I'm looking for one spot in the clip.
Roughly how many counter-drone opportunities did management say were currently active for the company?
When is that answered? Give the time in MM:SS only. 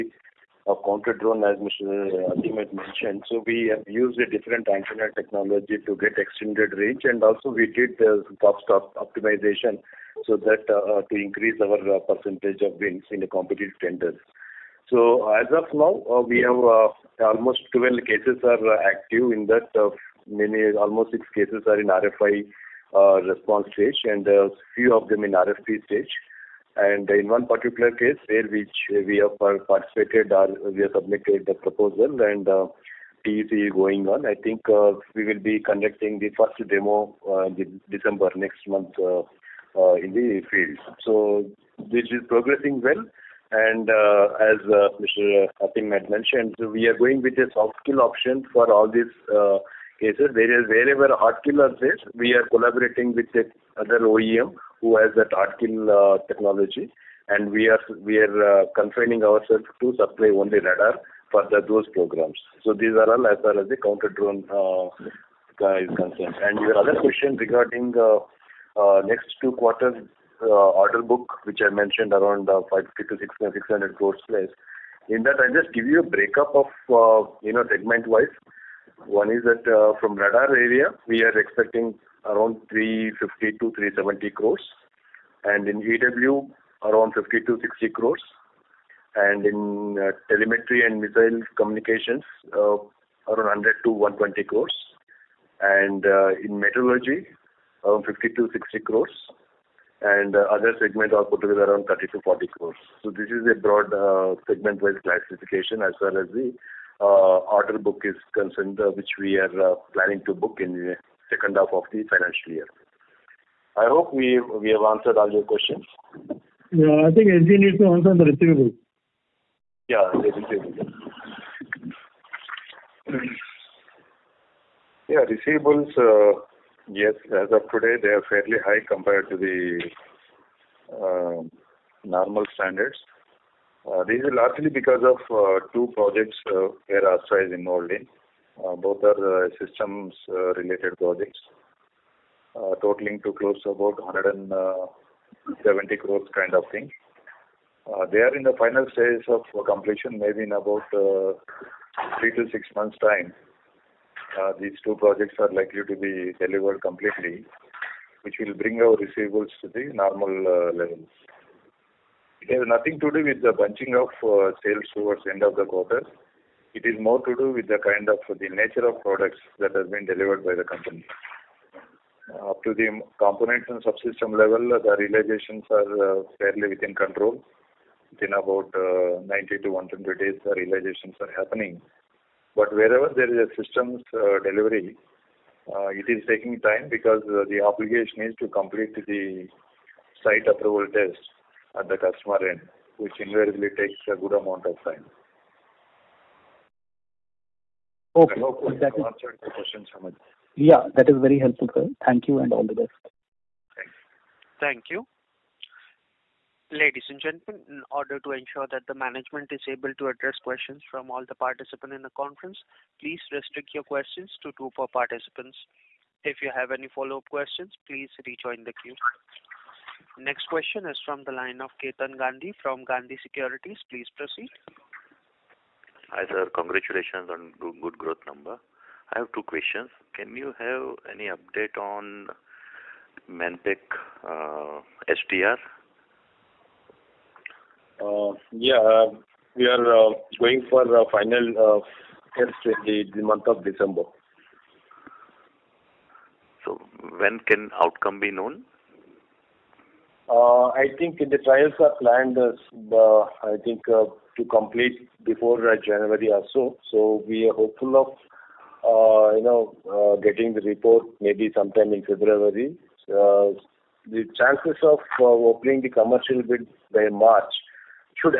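00:17.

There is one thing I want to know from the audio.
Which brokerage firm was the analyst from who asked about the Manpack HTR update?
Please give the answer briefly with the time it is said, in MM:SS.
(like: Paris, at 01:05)
Gandhi Securities, at 03:42.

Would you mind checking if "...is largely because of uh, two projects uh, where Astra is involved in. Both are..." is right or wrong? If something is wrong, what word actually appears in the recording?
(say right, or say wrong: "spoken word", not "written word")
right.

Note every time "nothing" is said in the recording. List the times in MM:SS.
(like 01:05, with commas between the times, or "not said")
02:42.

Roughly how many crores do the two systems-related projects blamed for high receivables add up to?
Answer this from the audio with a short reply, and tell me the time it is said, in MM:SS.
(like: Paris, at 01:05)
170 crores, at 02:24.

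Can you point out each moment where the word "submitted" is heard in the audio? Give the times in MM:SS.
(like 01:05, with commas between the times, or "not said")
00:30.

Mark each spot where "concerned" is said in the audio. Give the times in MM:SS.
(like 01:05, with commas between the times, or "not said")
01:05, 01:48.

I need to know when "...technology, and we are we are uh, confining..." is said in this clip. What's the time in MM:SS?
00:56.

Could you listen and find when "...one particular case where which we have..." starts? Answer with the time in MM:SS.
00:27.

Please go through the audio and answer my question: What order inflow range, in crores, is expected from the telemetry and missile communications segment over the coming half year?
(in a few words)
100 to 120 crores.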